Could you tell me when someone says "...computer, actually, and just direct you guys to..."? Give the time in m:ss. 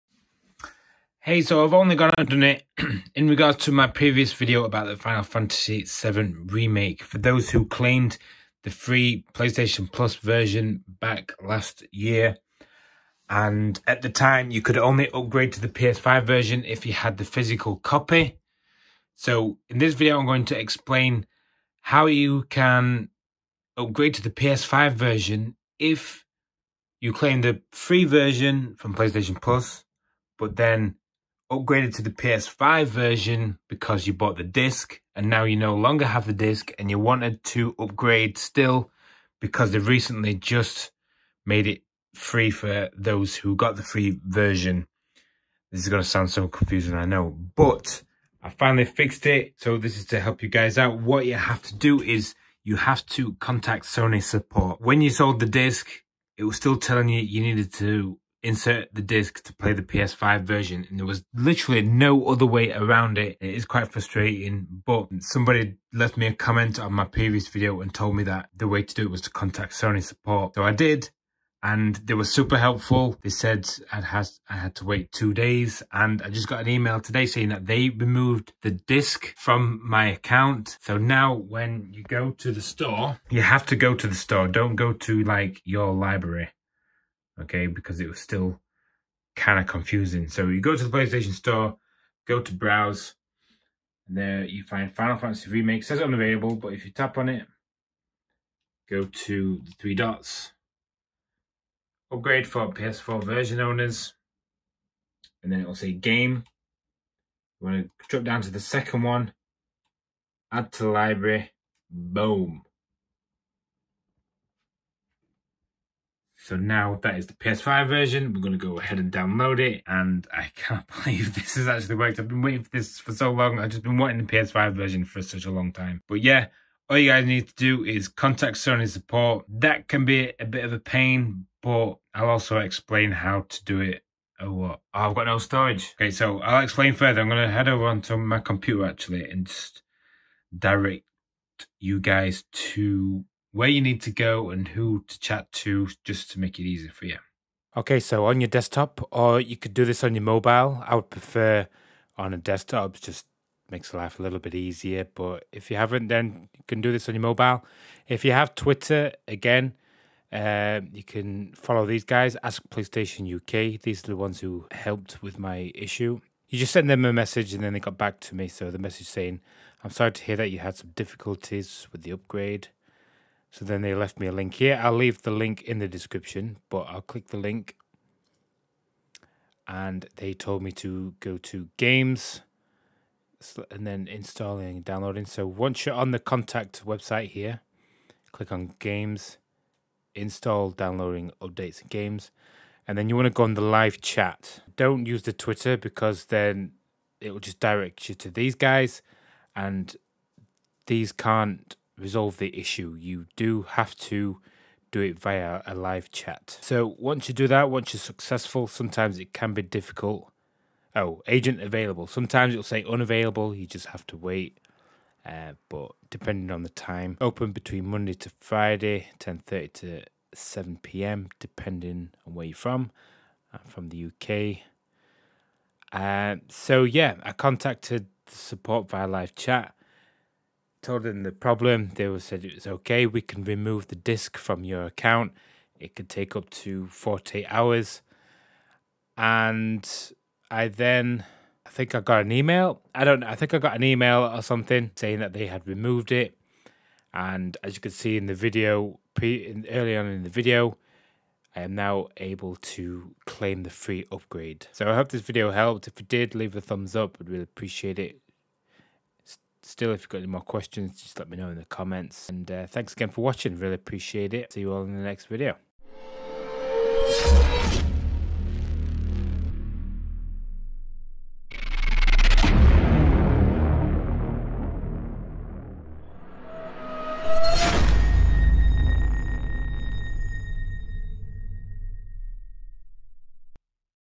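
2:18.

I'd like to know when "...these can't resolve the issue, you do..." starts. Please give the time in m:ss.
3:20.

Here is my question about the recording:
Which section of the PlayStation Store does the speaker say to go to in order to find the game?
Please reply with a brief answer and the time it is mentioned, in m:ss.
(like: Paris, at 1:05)
Browse, at 1:32.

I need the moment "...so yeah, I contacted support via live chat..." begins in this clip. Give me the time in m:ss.
3:46.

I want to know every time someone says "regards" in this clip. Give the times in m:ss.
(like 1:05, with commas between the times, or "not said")
0:03.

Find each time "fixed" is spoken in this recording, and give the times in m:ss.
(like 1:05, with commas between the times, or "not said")
0:48.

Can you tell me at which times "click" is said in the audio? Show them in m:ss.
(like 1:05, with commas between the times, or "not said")
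2:57, 3:08.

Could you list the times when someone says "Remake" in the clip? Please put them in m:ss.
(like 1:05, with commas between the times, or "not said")
0:06, 1:35.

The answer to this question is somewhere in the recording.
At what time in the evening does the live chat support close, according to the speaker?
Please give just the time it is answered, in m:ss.
3:40.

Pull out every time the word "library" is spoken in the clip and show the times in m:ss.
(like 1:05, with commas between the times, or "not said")
1:25, 1:50.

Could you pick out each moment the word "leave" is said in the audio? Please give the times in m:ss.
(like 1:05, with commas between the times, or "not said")
2:54, 4:16.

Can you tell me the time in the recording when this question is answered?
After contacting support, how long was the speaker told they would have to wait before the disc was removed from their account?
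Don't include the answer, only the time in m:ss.
1:15.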